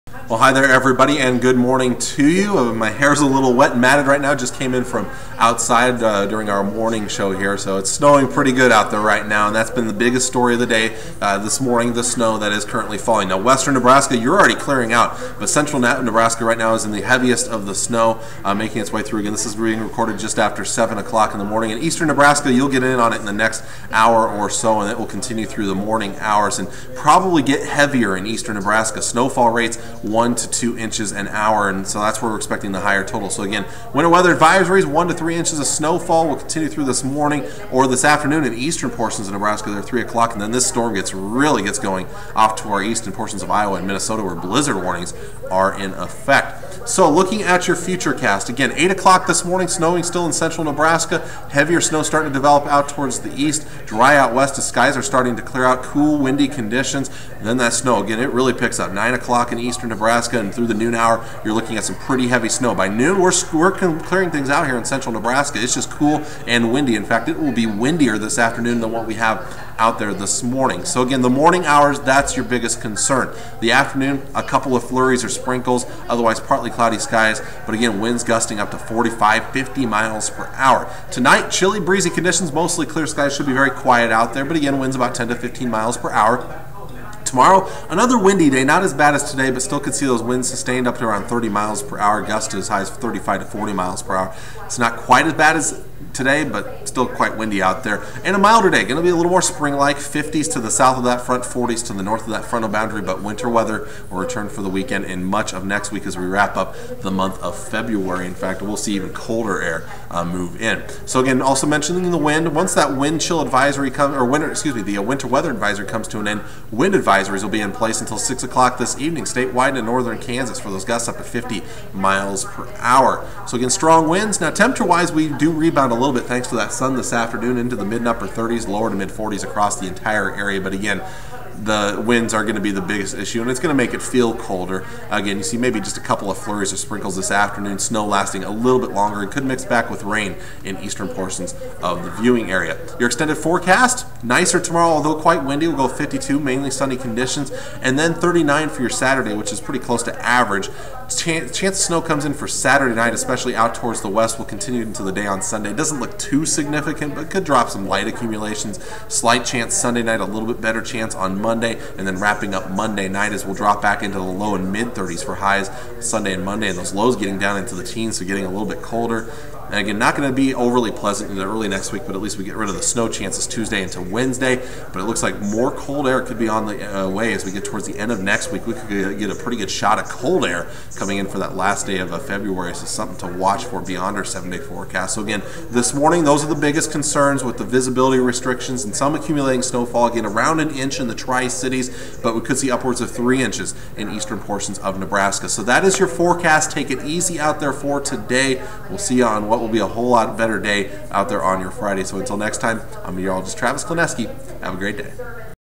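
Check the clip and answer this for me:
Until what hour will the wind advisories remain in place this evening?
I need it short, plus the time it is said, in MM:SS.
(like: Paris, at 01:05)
6 o'clock, at 01:58.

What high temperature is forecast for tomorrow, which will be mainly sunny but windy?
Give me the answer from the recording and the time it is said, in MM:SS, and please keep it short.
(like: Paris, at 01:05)
52, at 02:25.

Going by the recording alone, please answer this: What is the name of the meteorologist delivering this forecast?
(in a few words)
Travis Klanecky.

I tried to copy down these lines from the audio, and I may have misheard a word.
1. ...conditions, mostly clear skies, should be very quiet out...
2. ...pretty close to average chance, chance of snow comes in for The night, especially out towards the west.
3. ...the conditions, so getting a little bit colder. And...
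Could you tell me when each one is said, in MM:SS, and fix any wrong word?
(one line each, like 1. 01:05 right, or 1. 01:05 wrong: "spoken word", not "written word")
1. 01:22 right
2. 02:29 wrong: "Saturday", not "The"
3. 02:47 wrong: "teens", not "conditions".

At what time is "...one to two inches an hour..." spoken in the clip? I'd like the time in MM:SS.
00:30.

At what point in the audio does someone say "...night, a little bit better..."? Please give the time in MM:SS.
02:40.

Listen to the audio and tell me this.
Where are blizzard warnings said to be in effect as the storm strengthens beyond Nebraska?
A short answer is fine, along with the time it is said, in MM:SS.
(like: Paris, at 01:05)
Iowa and Minnesota, at 00:43.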